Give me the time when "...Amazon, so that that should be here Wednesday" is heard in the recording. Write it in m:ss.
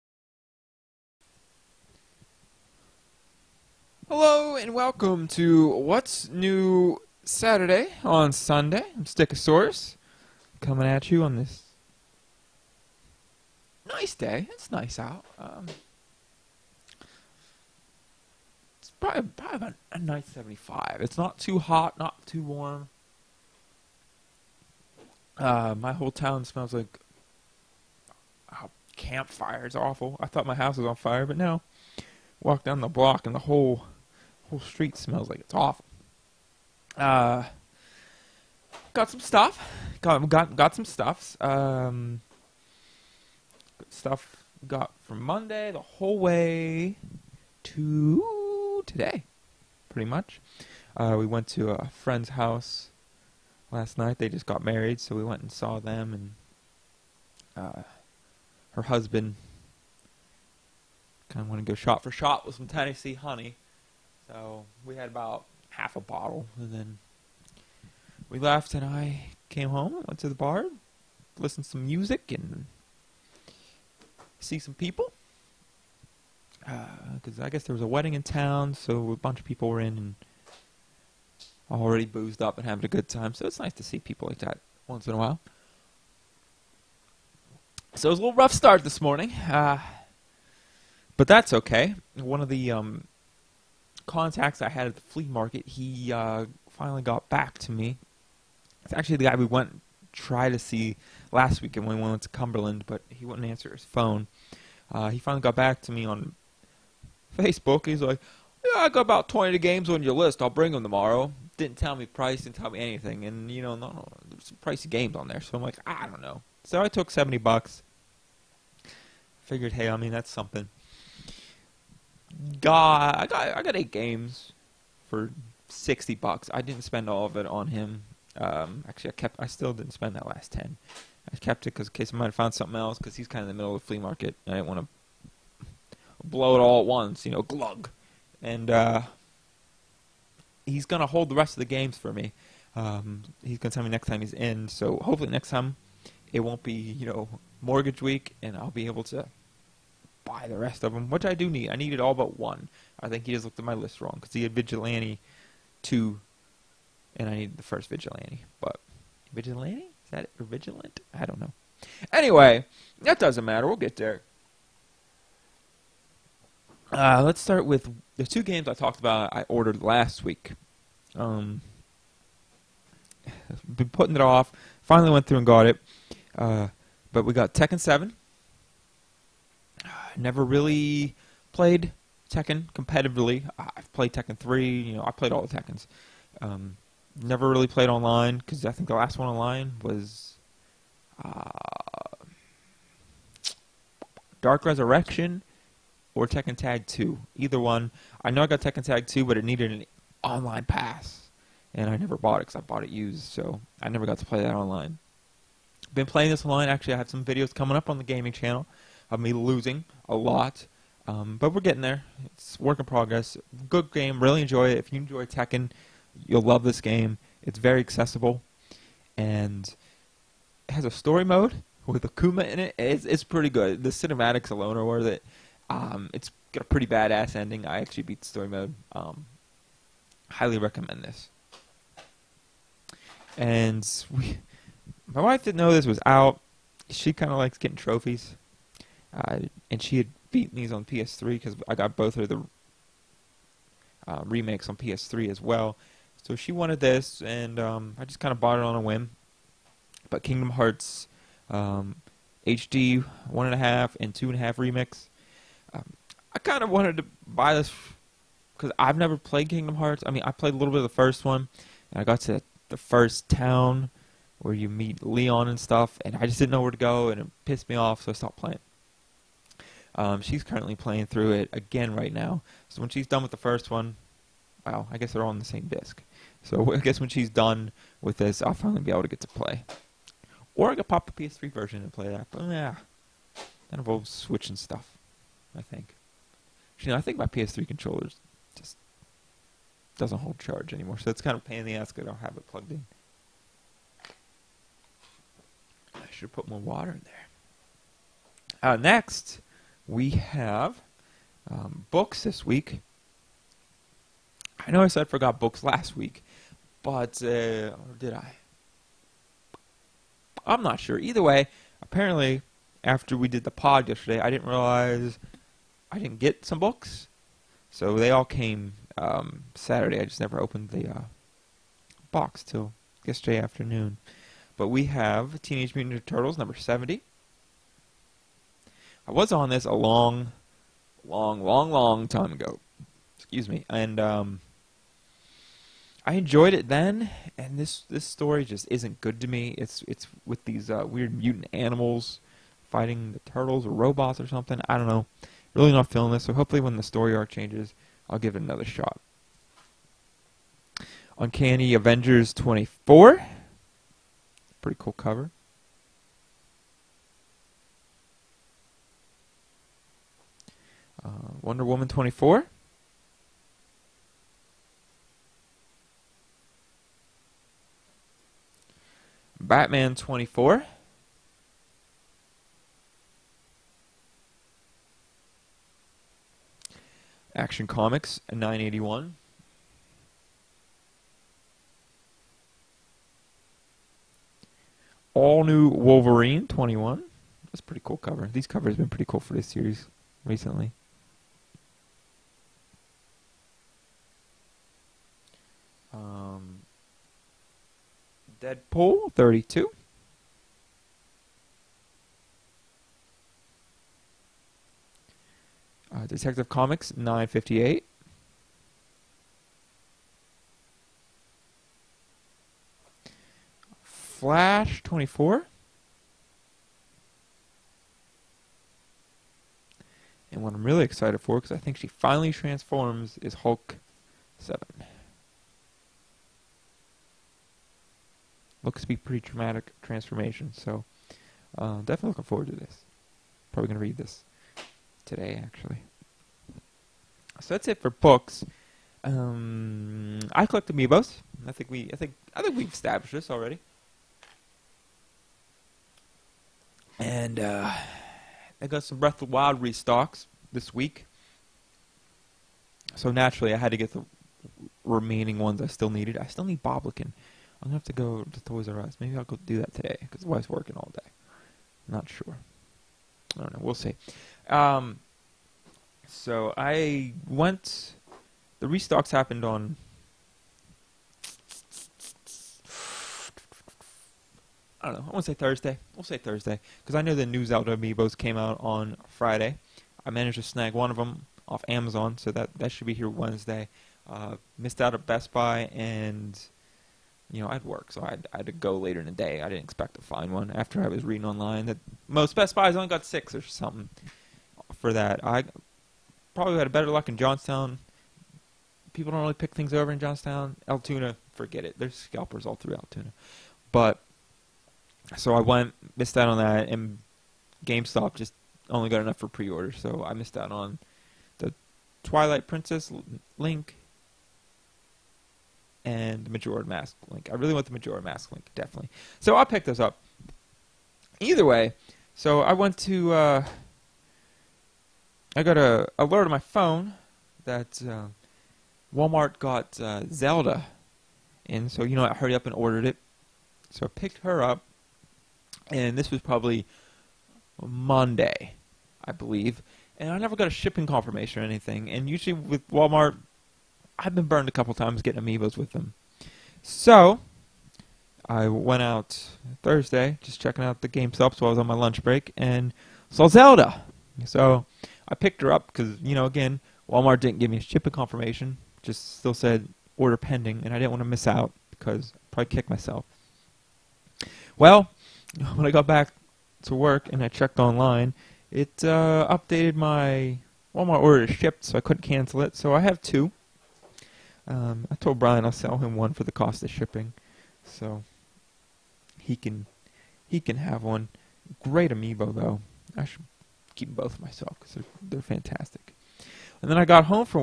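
8:01.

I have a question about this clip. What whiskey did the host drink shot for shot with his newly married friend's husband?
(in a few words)
Tennessee honey.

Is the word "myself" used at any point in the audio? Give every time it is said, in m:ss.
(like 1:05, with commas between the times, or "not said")
9:22, 9:44.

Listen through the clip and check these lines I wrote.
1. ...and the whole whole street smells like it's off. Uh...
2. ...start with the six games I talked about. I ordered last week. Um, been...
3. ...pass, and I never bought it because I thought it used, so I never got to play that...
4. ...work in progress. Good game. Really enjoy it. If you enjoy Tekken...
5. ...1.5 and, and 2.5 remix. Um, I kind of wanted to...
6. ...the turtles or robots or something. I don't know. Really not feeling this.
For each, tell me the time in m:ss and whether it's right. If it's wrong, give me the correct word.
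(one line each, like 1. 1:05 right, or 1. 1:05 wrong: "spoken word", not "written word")
1. 0:33 right
2. 2:47 wrong: "two", not "six"
3. 3:20 wrong: "bought", not "thought"
4. 3:32 right
5. 4:13 right
6. 5:43 right.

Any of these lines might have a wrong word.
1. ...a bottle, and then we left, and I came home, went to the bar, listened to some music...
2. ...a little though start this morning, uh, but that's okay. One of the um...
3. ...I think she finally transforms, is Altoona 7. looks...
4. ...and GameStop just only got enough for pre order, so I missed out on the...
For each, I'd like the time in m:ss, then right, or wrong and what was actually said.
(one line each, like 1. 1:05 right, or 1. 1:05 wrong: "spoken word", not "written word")
1. 1:05 right
2. 1:28 wrong: "rough", not "though"
3. 7:01 wrong: "Hulk", not "Altoona"
4. 8:26 right.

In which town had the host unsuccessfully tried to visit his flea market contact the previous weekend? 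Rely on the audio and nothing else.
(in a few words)
Cumberland.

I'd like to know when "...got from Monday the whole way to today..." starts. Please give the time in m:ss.
0:44.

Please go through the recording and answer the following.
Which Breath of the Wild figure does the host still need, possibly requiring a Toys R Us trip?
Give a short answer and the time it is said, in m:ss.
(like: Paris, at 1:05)
Boblikin, at 7:36.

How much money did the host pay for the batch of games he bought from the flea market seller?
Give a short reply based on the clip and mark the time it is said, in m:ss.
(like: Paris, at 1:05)
$60, at 2:05.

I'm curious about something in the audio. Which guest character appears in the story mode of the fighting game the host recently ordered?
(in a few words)
Akuma.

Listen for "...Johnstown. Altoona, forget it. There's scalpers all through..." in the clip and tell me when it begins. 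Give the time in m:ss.
8:19.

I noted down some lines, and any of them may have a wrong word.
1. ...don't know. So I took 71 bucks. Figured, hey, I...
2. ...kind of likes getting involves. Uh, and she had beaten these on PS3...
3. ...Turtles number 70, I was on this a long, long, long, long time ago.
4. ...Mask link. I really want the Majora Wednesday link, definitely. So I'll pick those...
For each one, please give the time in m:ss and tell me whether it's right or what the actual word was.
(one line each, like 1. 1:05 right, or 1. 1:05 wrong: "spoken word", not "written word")
1. 1:56 wrong: "70", not "71"
2. 3:57 wrong: "trophies", not "involves"
3. 5:26 right
4. 8:36 wrong: "Mask", not "Wednesday".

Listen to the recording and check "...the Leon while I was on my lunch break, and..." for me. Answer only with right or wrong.
wrong.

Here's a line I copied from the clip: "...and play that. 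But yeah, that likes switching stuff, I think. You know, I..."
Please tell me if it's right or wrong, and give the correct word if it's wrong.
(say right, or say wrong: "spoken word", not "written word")
wrong: "involves", not "likes".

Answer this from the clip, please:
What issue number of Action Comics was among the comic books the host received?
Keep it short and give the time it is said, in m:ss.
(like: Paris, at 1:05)
981, at 6:18.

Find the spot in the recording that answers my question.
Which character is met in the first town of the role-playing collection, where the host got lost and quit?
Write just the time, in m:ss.
4:25.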